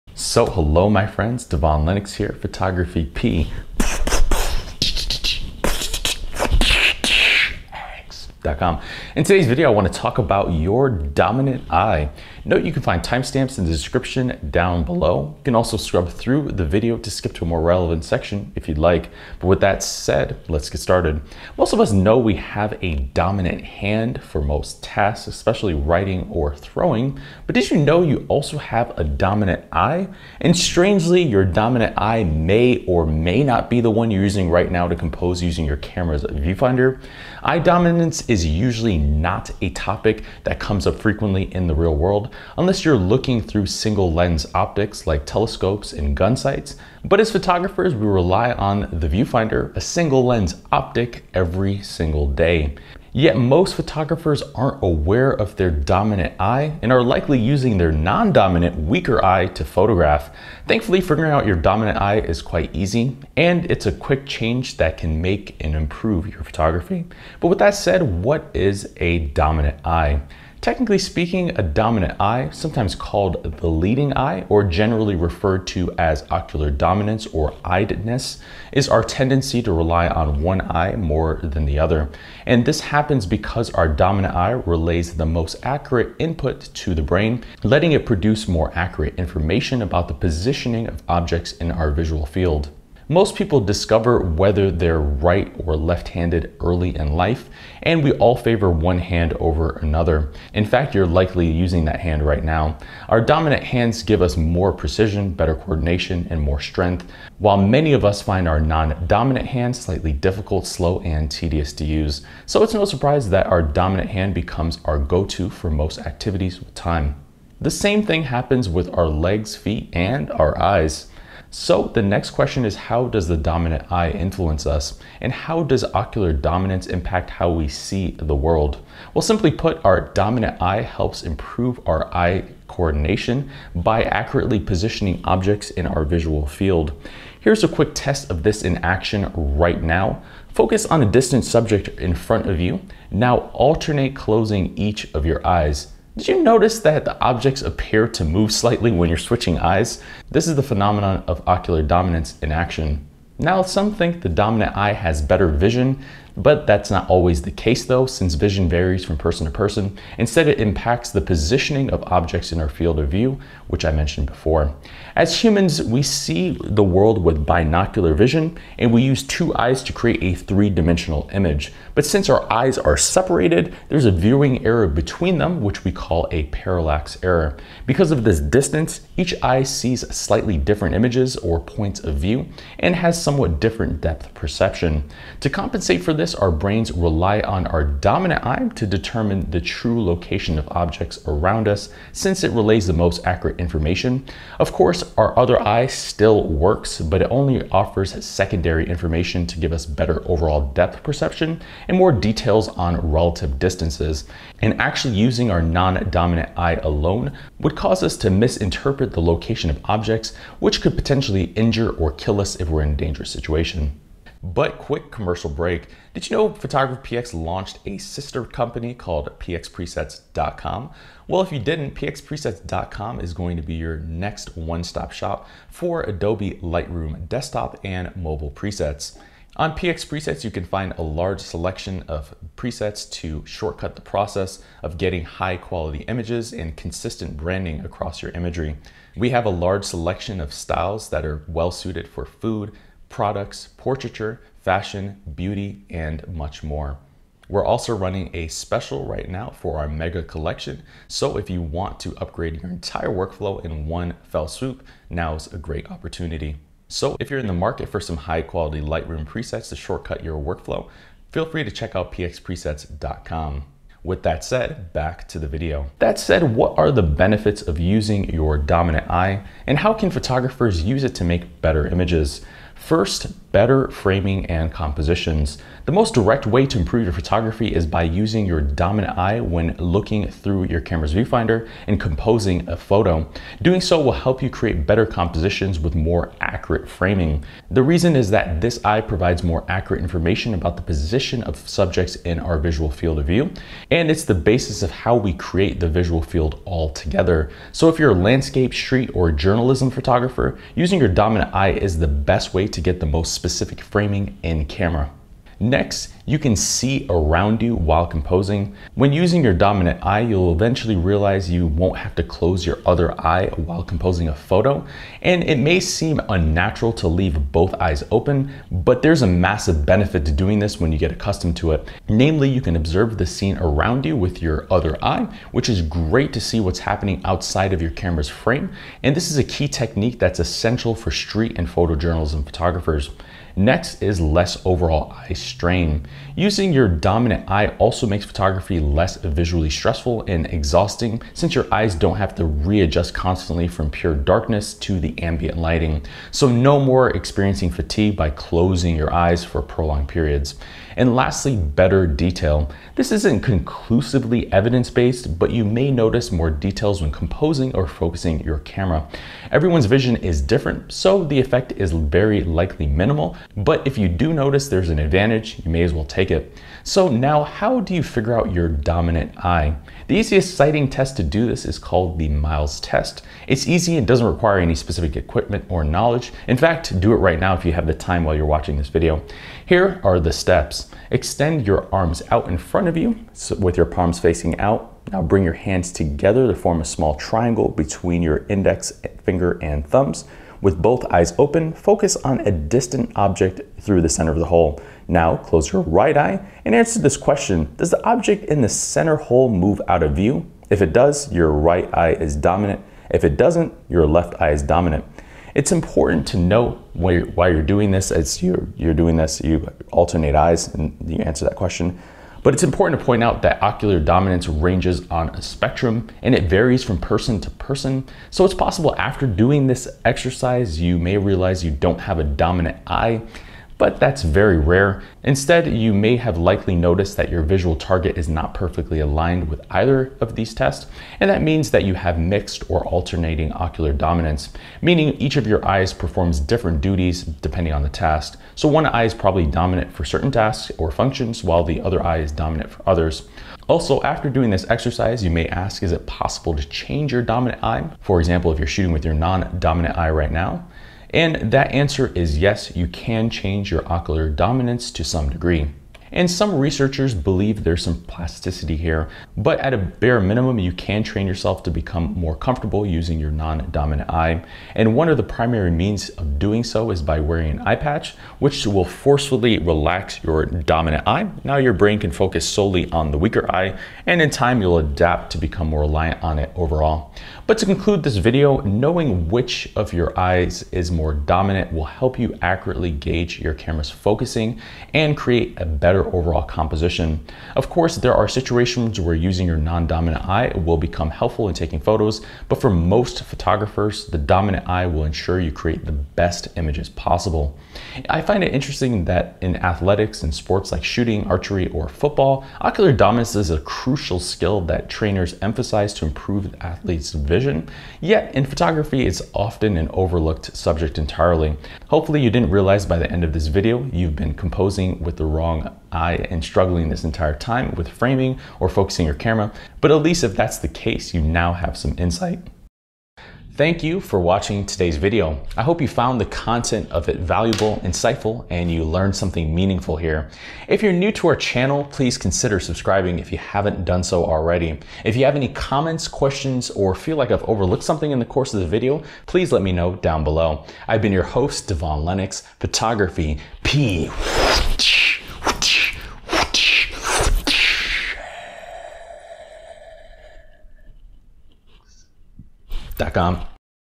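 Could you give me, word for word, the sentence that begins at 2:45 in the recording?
As humans, we see the world with binocular vision, and we use two eyes to create a three-dimensional image.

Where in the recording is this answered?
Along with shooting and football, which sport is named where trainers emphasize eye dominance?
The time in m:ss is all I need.
8:21.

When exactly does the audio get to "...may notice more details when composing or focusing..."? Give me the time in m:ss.
5:55.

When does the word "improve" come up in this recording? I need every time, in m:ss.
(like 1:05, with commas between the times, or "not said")
1:05, 2:11, 4:36, 8:26.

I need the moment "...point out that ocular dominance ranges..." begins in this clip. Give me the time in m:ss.
6:53.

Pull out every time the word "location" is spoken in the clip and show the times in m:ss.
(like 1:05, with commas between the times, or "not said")
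3:10, 3:29.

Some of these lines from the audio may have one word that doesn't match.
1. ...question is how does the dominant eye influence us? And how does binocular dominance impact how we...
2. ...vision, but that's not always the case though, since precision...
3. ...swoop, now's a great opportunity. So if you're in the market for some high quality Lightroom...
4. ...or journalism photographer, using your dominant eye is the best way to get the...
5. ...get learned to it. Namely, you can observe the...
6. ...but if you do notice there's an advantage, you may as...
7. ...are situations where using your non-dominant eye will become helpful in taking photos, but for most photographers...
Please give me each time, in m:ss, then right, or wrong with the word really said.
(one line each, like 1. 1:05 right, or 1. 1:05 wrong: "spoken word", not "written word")
1. 2:02 wrong: "ocular", not "binocular"
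2. 2:35 wrong: "vision", not "precision"
3. 4:14 right
4. 4:59 right
5. 5:20 wrong: "accustomed", not "learned"
6. 6:03 right
7. 8:08 right.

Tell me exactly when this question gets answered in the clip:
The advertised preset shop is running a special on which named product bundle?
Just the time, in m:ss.
4:09.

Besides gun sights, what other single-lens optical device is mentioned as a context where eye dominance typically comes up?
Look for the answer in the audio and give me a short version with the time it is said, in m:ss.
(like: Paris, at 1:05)
Telescopes, at 0:45.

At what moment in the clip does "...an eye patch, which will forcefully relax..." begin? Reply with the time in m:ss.
7:47.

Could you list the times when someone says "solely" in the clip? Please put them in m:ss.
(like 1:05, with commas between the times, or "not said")
7:52.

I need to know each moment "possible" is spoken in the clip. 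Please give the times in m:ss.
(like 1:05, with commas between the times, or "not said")
6:58, 7:26, 8:16.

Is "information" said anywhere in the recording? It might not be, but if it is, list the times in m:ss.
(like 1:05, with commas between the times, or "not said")
1:29, 3:13, 3:18, 4:50.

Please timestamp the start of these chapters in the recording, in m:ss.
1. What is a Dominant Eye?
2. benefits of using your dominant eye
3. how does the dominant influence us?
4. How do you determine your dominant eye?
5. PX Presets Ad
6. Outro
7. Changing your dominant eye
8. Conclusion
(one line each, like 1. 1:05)
1. 1:07
2. 4:25
3. 2:01
4. 6:06
5. 3:34
6. 8:42
7. 7:23
8. 7:57.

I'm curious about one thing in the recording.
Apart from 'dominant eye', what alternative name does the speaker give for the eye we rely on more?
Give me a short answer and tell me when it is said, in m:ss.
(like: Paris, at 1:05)
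Leading eye, at 1:13.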